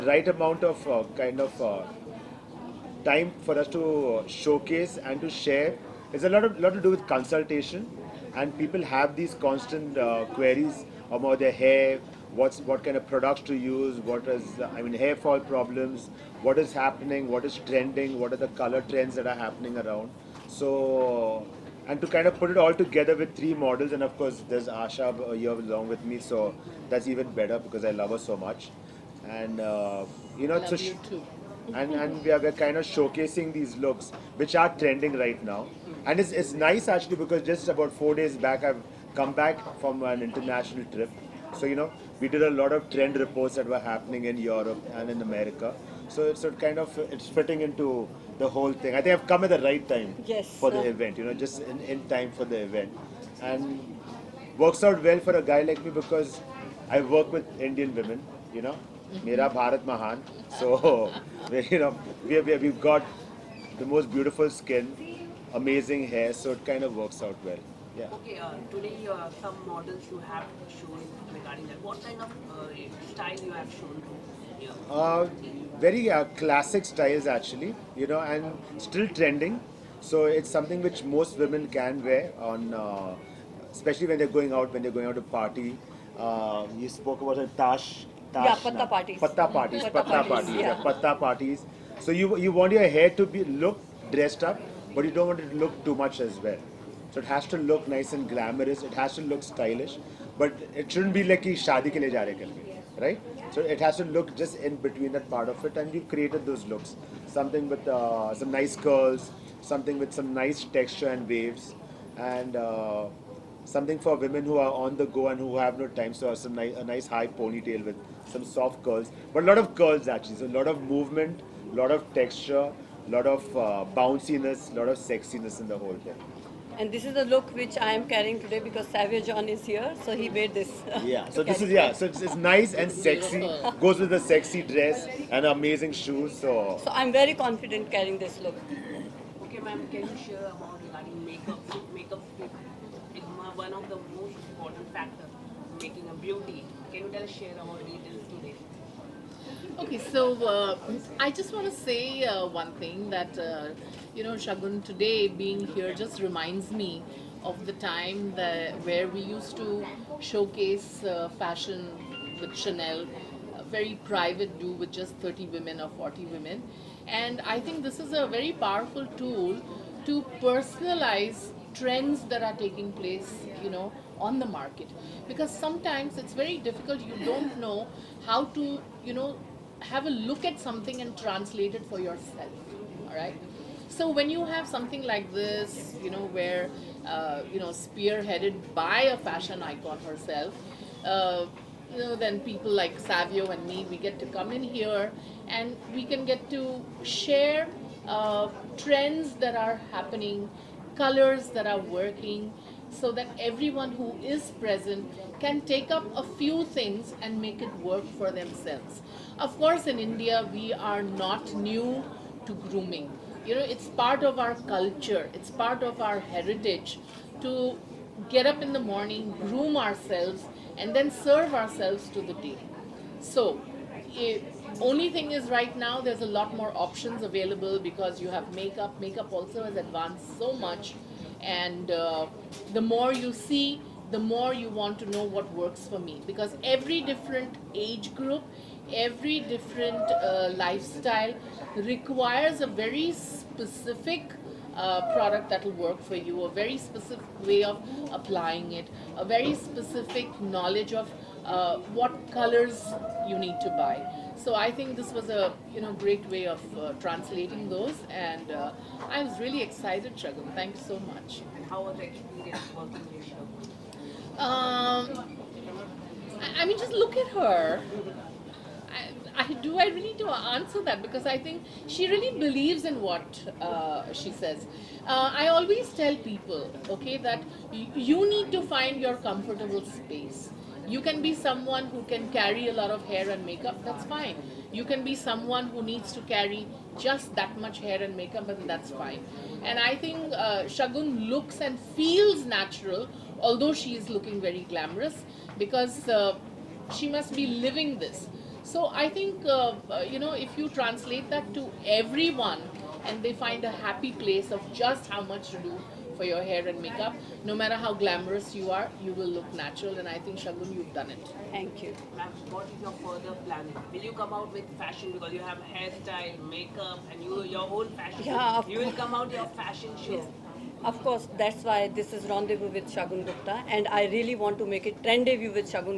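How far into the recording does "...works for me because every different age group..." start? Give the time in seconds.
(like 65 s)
235 s.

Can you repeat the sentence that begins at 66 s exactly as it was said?
So it kind of works out well.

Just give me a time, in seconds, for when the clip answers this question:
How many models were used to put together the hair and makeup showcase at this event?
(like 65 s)
23 s.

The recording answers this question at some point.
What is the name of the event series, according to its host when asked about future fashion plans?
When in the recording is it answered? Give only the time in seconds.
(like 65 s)
322 s.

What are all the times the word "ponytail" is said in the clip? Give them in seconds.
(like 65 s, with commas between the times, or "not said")
117 s.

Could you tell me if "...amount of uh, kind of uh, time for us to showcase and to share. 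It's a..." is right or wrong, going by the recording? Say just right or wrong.
right.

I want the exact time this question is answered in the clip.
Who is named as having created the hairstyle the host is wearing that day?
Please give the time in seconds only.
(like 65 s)
128 s.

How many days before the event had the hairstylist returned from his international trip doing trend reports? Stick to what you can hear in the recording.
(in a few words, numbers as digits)
4.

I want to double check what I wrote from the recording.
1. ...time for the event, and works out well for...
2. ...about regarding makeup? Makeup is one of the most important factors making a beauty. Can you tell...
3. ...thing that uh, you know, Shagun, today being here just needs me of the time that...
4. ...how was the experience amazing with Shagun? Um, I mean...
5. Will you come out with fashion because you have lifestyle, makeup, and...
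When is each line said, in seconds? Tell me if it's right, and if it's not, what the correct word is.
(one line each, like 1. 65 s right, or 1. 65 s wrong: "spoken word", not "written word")
1. 52 s right
2. 140 s right
3. 152 s wrong: "reminds", not "needs"
4. 261 s wrong: "working", not "amazing"
5. 313 s wrong: "hairstyle", not "lifestyle".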